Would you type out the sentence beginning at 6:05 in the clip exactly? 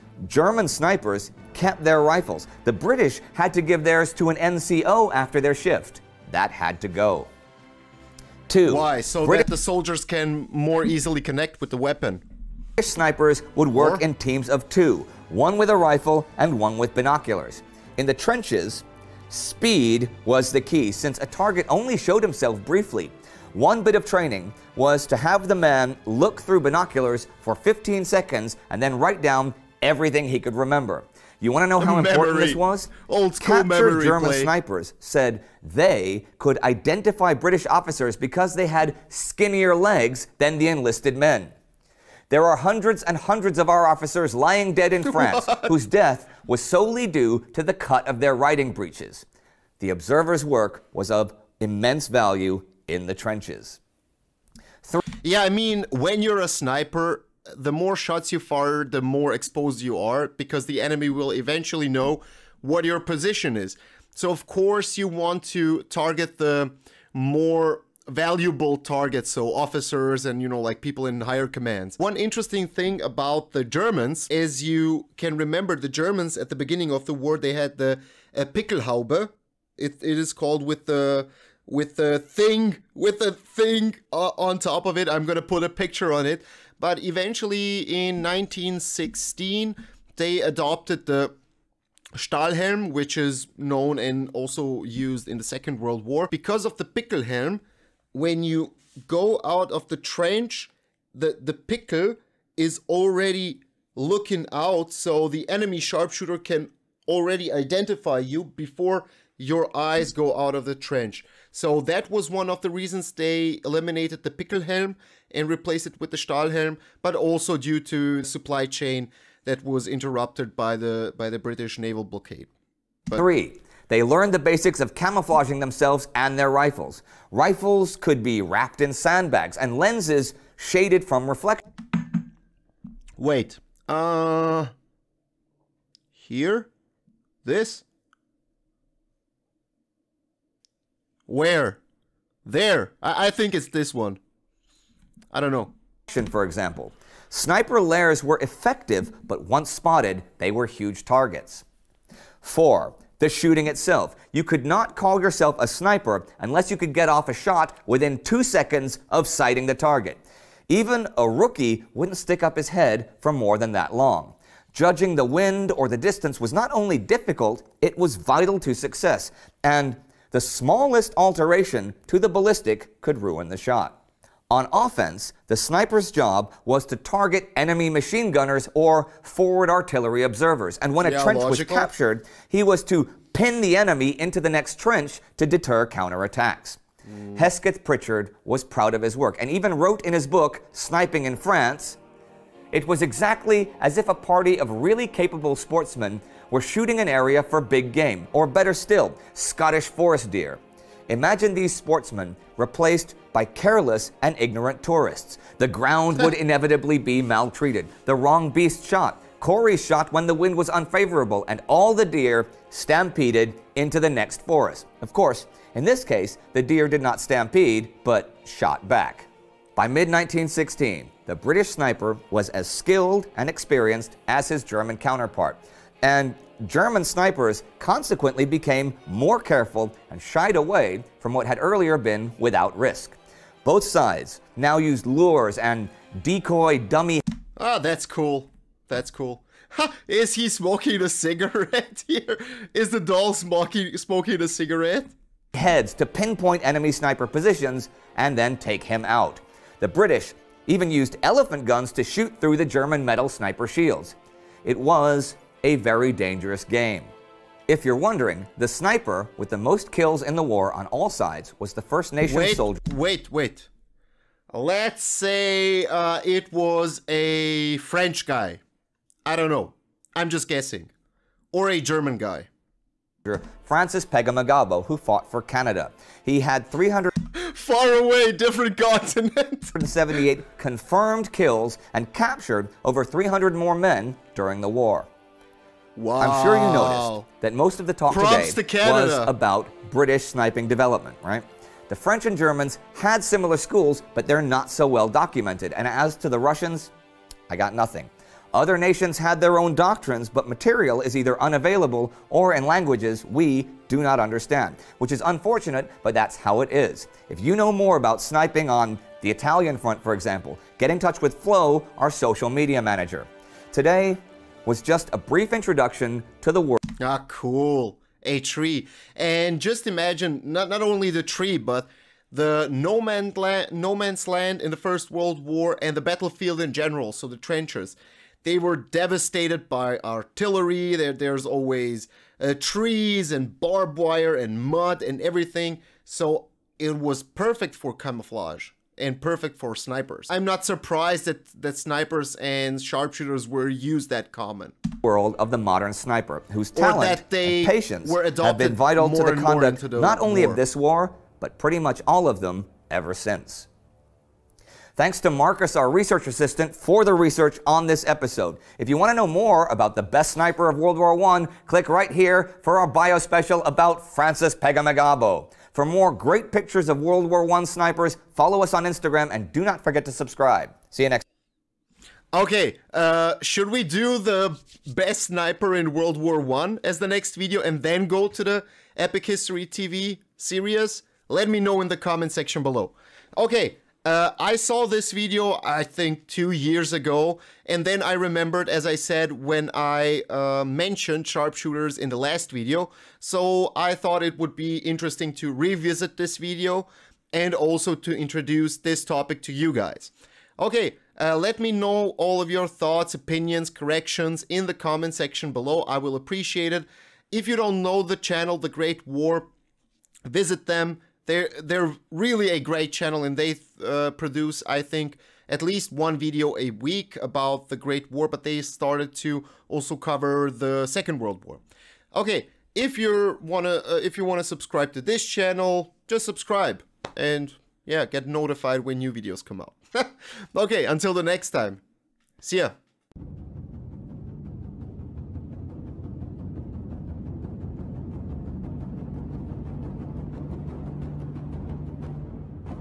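For more great pictures of World War I snipers, follow us on Instagram and do not forget to subscribe.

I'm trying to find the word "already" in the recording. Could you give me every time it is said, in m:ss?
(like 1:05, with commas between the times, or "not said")
1:42, 1:47.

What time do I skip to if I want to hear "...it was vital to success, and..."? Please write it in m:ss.
2:47.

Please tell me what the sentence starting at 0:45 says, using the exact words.
whose death was solely due to the cut of their riding breeches.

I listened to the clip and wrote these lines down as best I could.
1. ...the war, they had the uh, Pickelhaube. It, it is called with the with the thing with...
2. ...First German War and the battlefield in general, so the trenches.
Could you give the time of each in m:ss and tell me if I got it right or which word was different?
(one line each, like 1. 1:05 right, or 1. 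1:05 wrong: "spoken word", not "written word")
1. 1:17 right
2. 5:24 wrong: "World", not "German".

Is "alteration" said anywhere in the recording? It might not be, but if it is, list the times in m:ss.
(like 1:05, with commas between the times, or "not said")
2:51.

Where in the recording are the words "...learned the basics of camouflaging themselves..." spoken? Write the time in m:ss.
2:04.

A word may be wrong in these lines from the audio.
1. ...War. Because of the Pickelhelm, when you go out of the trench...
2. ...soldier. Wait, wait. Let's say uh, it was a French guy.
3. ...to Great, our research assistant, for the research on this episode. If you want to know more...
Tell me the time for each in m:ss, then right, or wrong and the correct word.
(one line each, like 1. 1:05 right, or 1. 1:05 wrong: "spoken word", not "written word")
1. 1:36 right
2. 4:22 right
3. 5:55 wrong: "Marcus", not "Great".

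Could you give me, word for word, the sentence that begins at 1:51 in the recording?
So that was one of the reasons they eliminated the pickle helm and replaced it with the Stahlhelm.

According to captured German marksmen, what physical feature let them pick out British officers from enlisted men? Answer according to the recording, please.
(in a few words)
Skinnier legs.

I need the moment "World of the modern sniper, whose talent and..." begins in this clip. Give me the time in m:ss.
5:45.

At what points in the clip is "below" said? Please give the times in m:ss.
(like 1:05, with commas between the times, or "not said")
6:22, 6:45.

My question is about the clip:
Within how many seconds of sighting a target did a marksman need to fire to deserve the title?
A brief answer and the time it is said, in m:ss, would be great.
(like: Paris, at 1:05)
Two seconds, at 2:38.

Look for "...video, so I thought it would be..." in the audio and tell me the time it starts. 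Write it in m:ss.
6:32.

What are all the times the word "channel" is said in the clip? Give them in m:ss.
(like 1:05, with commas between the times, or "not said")
6:48, 6:52, 7:05.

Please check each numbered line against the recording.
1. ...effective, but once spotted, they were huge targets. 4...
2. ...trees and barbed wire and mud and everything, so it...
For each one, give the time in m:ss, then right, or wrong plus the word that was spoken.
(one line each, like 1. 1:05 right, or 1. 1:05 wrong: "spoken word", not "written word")
1. 2:28 right
2. 5:32 right.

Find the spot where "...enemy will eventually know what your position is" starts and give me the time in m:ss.
1:00.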